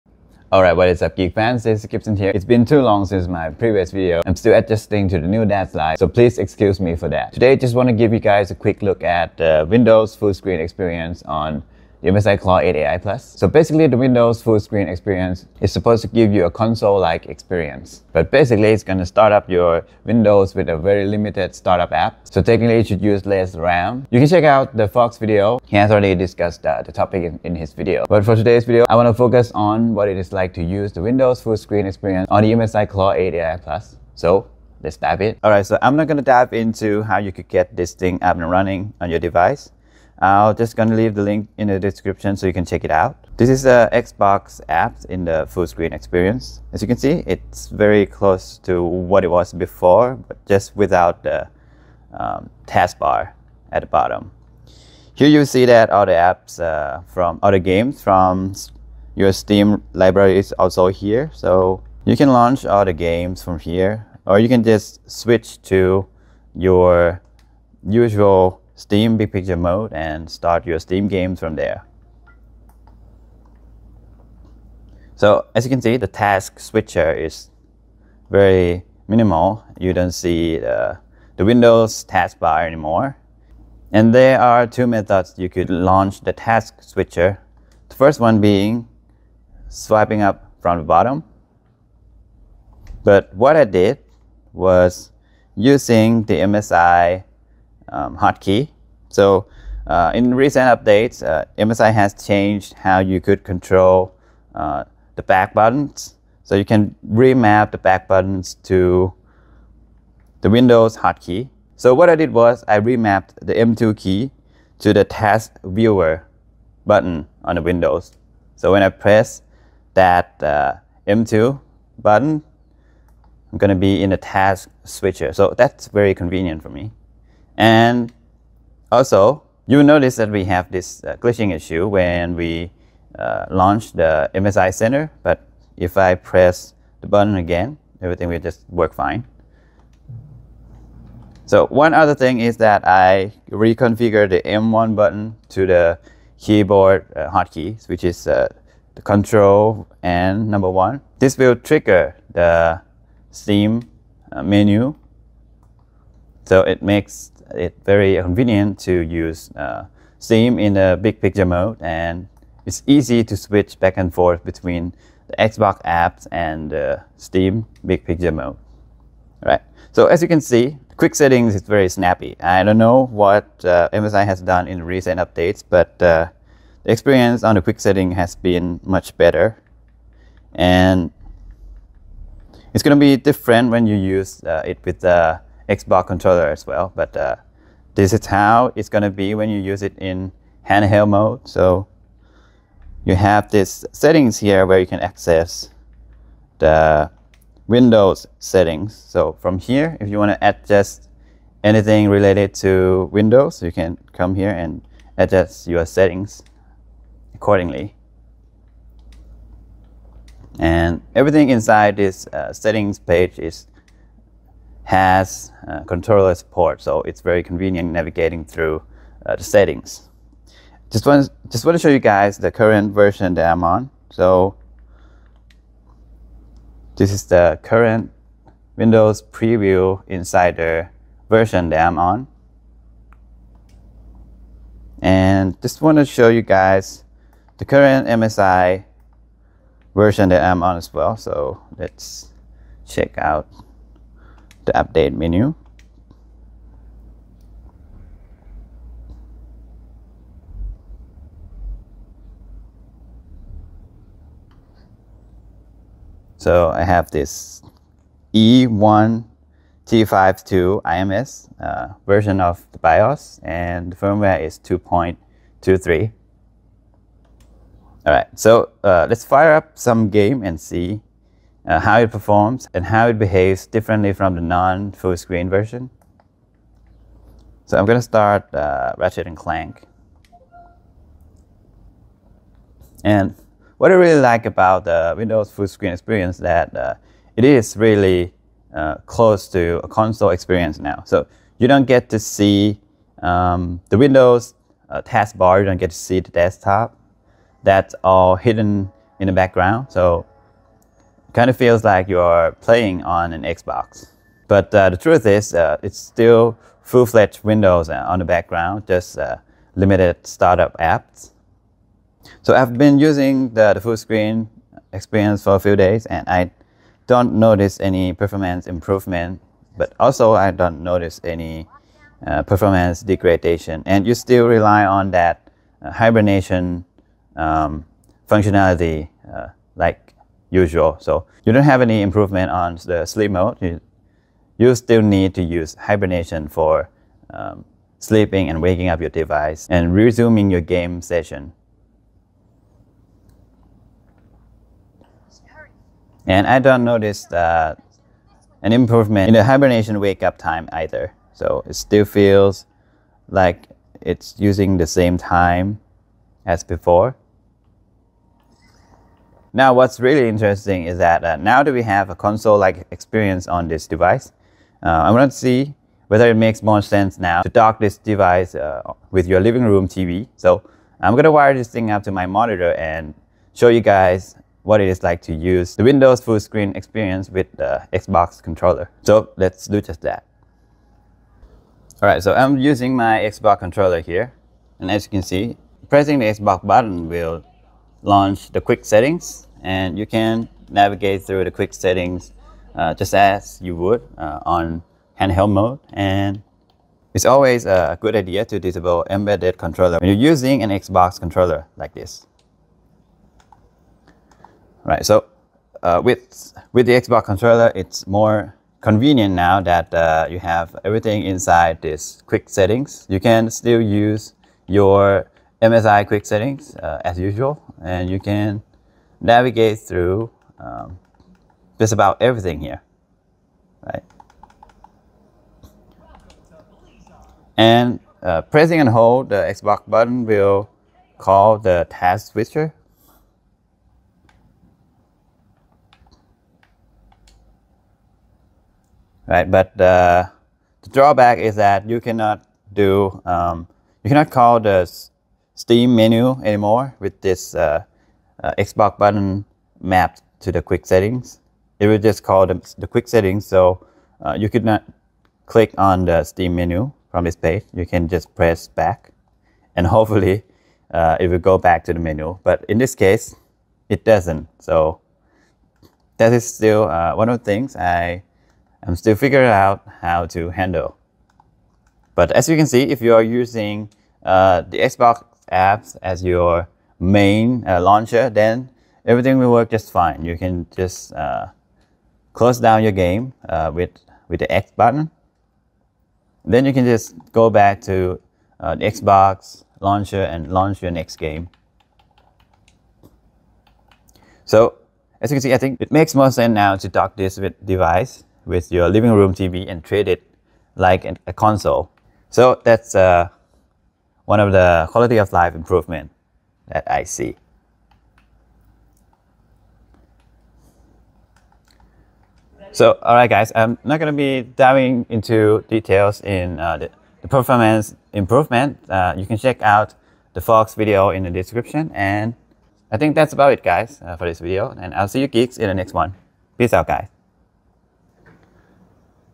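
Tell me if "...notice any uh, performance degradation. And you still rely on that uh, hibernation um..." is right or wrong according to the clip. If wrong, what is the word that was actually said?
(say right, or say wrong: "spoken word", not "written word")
right.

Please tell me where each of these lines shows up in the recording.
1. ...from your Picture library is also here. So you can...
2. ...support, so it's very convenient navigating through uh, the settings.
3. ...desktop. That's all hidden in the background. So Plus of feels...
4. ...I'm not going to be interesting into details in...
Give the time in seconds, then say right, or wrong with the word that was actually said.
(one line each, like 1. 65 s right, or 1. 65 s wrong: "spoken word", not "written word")
1. 58 s wrong: "Steam", not "Picture"
2. 216 s right
3. 296 s wrong: "Kind", not "Plus"
4. 513 s wrong: "diving", not "interesting".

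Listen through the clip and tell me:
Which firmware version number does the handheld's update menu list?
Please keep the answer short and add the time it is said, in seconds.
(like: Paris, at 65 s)
2.23, at 264 s.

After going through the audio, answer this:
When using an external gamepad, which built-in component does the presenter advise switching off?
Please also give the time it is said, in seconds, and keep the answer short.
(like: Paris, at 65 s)
Embedded controller, at 399 s.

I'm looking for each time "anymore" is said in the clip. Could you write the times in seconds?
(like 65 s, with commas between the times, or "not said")
82 s, 446 s.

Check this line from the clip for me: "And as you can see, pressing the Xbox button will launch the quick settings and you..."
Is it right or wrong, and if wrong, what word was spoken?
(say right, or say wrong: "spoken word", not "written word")
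right.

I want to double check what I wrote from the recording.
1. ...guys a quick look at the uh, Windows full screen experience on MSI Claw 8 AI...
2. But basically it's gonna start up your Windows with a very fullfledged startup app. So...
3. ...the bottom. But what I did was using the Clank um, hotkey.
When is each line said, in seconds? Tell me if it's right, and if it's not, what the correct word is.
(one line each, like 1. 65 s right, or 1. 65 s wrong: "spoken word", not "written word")
1. 8 s right
2. 18 s wrong: "limited", not "fullfledged"
3. 90 s wrong: "MSI", not "Clank".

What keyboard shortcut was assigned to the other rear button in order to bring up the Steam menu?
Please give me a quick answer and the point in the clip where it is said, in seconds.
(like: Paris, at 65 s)
Control and 1, at 149 s.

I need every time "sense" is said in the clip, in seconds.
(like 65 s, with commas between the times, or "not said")
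366 s, 496 s.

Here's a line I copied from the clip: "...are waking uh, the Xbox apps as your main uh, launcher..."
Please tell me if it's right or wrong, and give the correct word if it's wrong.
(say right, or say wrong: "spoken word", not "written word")
wrong: "using", not "waking".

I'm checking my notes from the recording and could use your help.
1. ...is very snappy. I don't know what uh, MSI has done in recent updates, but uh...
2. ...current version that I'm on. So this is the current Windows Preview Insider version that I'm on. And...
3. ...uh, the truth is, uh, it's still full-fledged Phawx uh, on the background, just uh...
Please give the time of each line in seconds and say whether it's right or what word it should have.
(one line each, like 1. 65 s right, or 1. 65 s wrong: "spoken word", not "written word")
1. 171 s right
2. 222 s right
3. 304 s wrong: "Windows", not "Phawx".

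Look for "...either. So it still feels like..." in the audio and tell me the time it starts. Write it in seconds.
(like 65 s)
350 s.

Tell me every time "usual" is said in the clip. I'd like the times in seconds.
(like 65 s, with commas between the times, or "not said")
67 s, 330 s, 417 s.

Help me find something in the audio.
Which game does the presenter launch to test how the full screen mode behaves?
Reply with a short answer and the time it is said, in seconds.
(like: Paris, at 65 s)
Ratchet and Clank, at 278 s.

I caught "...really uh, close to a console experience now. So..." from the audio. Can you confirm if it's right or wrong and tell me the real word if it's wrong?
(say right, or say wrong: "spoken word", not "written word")
right.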